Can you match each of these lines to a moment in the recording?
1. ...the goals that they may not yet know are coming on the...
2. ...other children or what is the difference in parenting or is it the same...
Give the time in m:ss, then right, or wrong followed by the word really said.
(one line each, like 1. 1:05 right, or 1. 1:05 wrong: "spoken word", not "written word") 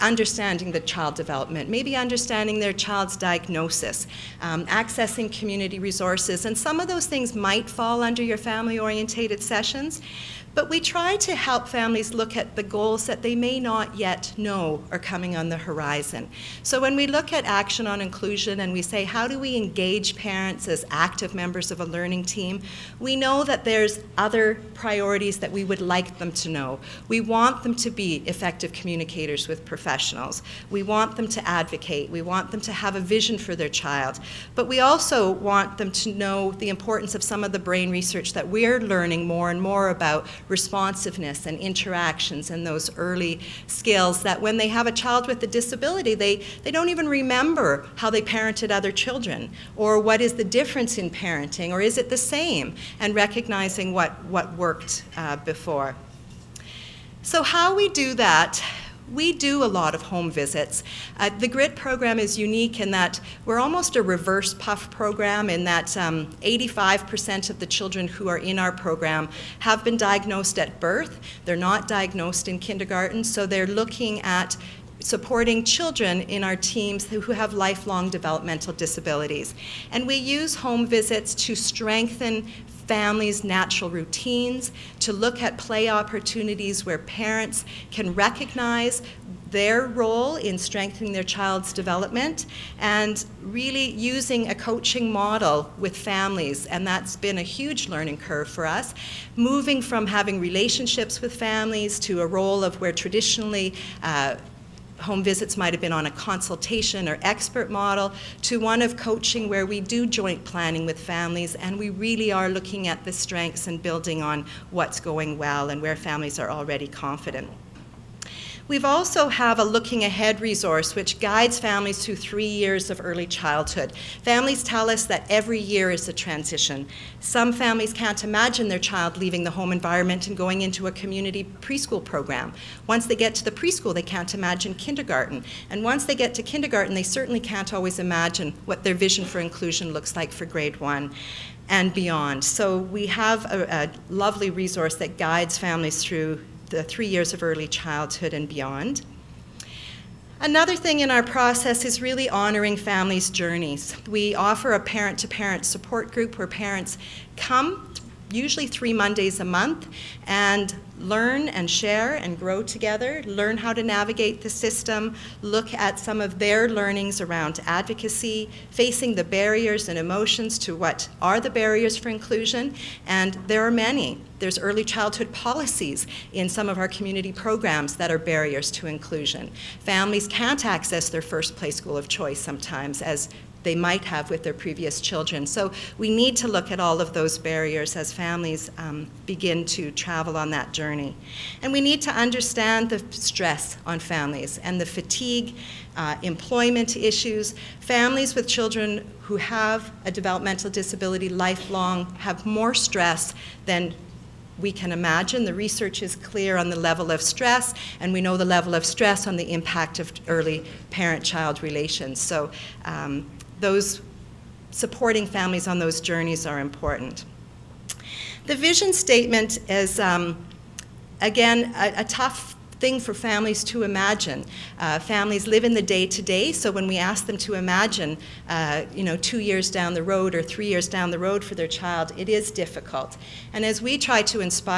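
1. 0:12 right
2. 0:48 right.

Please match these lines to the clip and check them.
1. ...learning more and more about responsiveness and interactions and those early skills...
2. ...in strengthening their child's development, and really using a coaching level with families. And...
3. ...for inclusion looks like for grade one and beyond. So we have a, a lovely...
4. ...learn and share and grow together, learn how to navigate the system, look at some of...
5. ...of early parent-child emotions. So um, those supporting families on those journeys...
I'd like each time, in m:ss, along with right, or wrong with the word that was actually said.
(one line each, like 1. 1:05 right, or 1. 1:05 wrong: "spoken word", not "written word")
1. 0:38 right
2. 1:30 wrong: "model", not "level"
3. 2:19 right
4. 2:40 right
5. 3:29 wrong: "relations", not "emotions".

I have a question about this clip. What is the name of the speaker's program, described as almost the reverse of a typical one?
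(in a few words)
Grit.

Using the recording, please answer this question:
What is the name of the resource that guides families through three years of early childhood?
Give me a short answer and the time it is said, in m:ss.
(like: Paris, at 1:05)
Looking Ahead, at 1:59.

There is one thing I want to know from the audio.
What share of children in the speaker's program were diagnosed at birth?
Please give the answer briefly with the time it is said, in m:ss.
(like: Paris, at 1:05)
85%, at 1:05.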